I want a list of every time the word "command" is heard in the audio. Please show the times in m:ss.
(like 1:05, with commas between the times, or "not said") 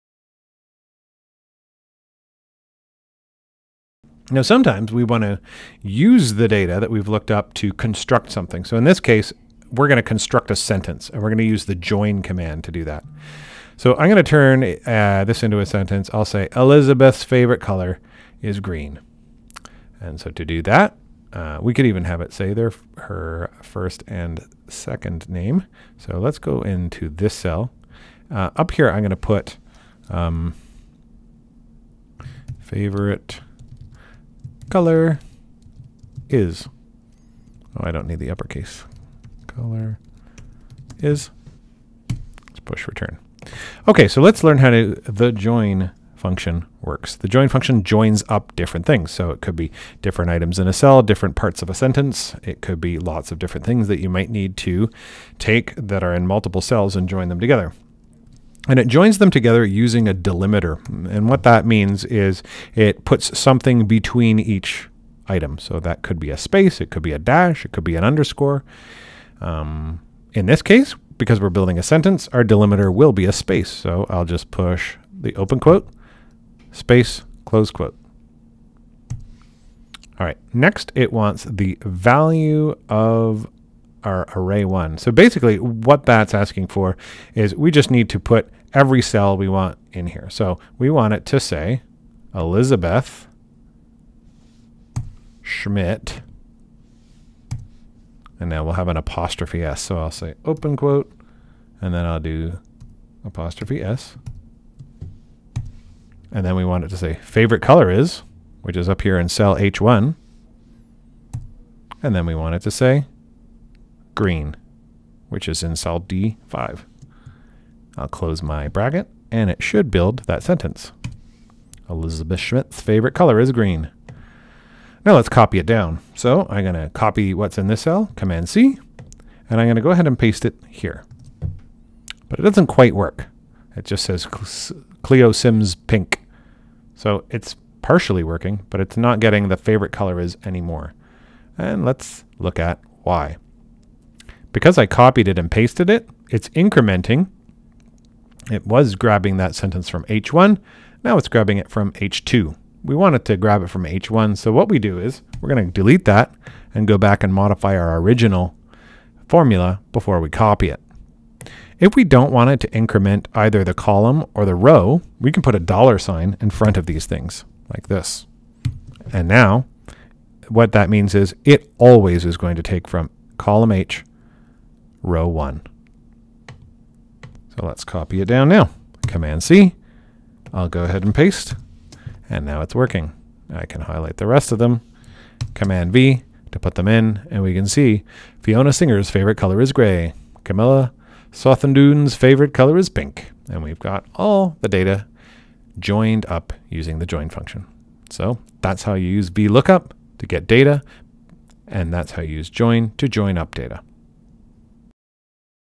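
0:12, 2:08, 2:59, 3:05.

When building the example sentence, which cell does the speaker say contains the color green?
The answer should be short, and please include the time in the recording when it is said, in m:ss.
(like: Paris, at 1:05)
D5, at 1:55.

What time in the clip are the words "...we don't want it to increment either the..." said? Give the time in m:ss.
2:41.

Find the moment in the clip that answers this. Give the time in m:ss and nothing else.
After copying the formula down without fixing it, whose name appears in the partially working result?
2:15.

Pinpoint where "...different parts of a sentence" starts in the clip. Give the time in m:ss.
0:51.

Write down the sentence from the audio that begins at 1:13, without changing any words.
So I'll just push the open quote, space, close quote.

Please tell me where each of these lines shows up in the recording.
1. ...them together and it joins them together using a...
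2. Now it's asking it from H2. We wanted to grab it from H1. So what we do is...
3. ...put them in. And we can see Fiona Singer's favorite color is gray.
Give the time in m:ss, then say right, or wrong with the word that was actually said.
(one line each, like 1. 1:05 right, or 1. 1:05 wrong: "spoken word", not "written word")
1. 0:57 right
2. 2:31 wrong: "grabbing", not "asking"
3. 3:06 right.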